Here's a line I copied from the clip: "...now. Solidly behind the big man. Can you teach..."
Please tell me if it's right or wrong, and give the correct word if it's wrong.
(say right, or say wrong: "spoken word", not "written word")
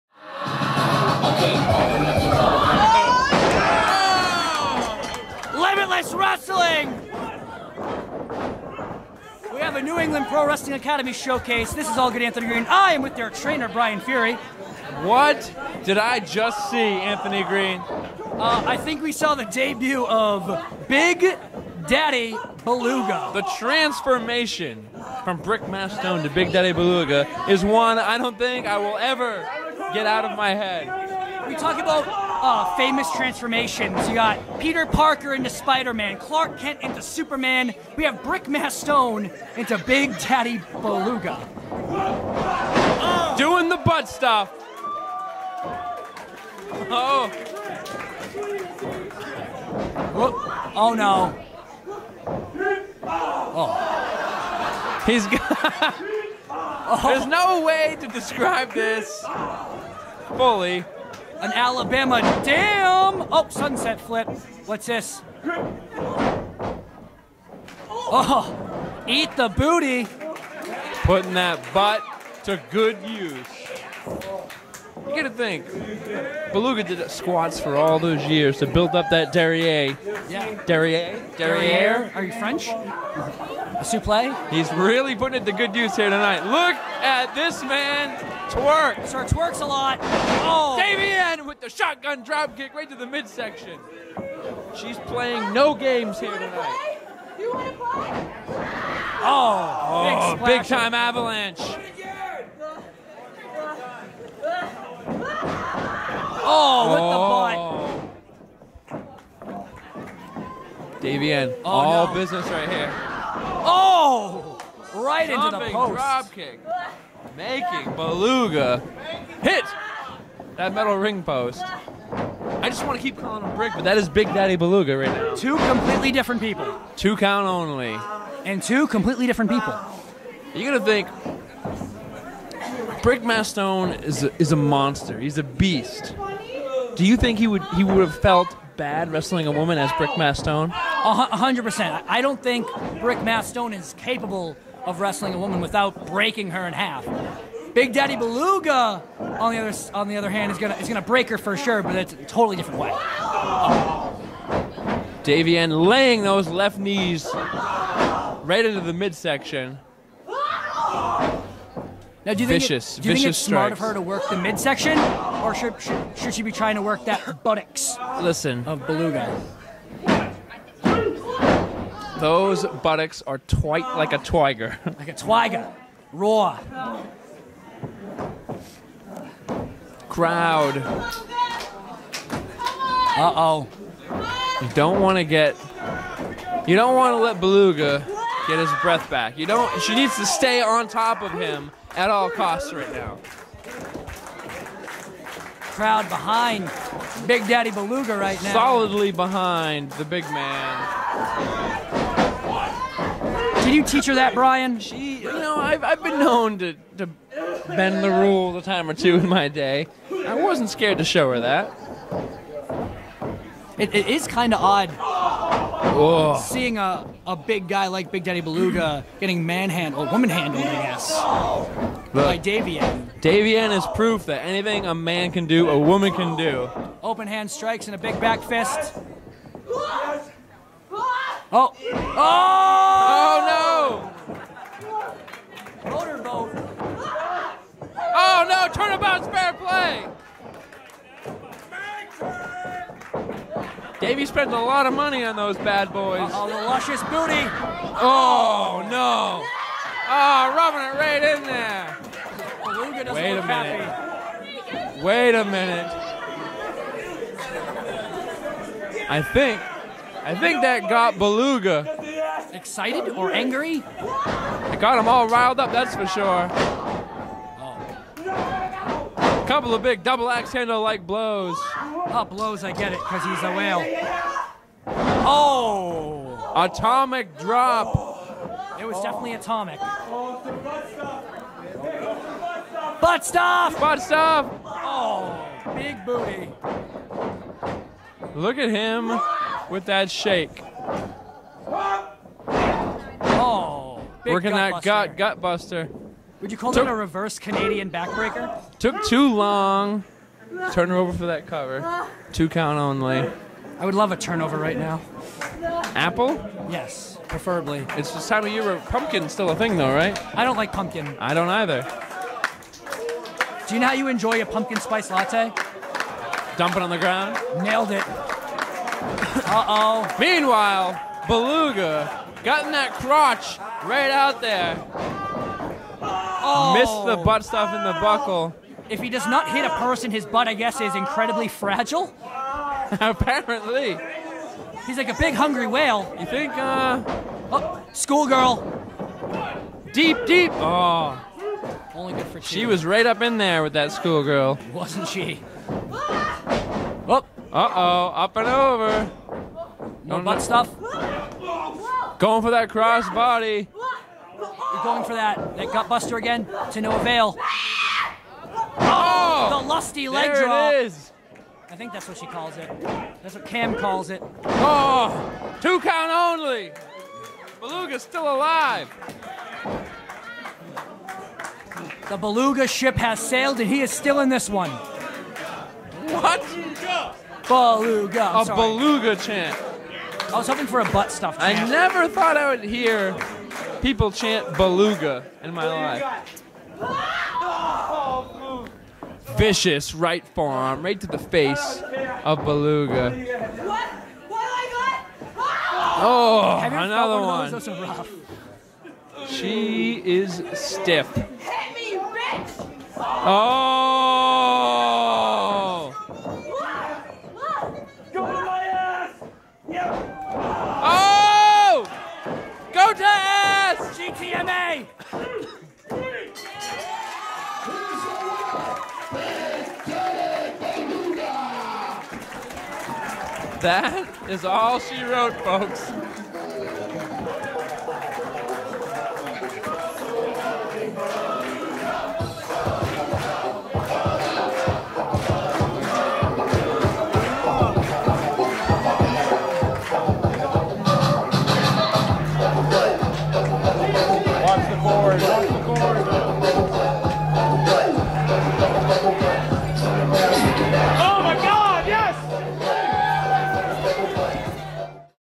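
right.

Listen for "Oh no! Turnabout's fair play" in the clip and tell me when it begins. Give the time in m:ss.
3:57.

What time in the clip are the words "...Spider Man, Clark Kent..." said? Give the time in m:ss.
0:35.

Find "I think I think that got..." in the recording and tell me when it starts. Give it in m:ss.
4:19.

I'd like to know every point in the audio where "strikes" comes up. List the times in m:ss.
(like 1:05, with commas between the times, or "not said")
2:43, 3:47.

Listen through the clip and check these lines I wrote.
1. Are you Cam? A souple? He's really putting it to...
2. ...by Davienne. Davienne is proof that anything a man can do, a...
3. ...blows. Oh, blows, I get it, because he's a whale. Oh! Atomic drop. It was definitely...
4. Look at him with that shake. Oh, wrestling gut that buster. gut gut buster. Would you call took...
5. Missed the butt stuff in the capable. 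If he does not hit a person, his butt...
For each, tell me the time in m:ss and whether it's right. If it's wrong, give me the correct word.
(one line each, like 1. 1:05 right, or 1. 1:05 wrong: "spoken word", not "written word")
1. 1:22 wrong: "French", not "Cam"
2. 3:42 right
3. 4:31 right
4. 4:48 wrong: "working", not "wrestling"
5. 5:26 wrong: "buckle", not "capable".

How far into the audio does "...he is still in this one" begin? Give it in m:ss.
6:13.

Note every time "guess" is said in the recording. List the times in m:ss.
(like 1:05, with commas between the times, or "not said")
3:40, 5:30.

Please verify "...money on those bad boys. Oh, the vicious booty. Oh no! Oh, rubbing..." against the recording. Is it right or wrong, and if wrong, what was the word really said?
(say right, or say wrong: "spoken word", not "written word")
wrong: "luscious", not "vicious".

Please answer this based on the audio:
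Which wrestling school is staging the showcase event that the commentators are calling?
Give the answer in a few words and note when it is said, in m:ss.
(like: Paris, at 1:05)
New England Pro Wrestling Academy, at 0:09.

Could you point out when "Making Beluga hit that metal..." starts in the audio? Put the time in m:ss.
1:57.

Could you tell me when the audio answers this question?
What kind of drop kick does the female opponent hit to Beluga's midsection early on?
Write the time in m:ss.
1:31.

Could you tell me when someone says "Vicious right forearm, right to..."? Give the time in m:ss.
6:29.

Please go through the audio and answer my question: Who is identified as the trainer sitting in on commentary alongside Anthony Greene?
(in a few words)
Brian Fury.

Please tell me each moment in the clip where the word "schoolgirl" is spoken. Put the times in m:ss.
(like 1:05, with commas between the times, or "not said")
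5:37, 5:43.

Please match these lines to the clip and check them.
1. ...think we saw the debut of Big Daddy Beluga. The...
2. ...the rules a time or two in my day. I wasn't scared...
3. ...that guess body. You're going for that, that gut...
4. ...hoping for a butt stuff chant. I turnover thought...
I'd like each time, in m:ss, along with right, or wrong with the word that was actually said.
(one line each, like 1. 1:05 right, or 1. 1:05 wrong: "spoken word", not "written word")
1. 0:18 right
2. 3:28 right
3. 5:52 wrong: "cross", not "guess"
4. 6:20 wrong: "never", not "turnover".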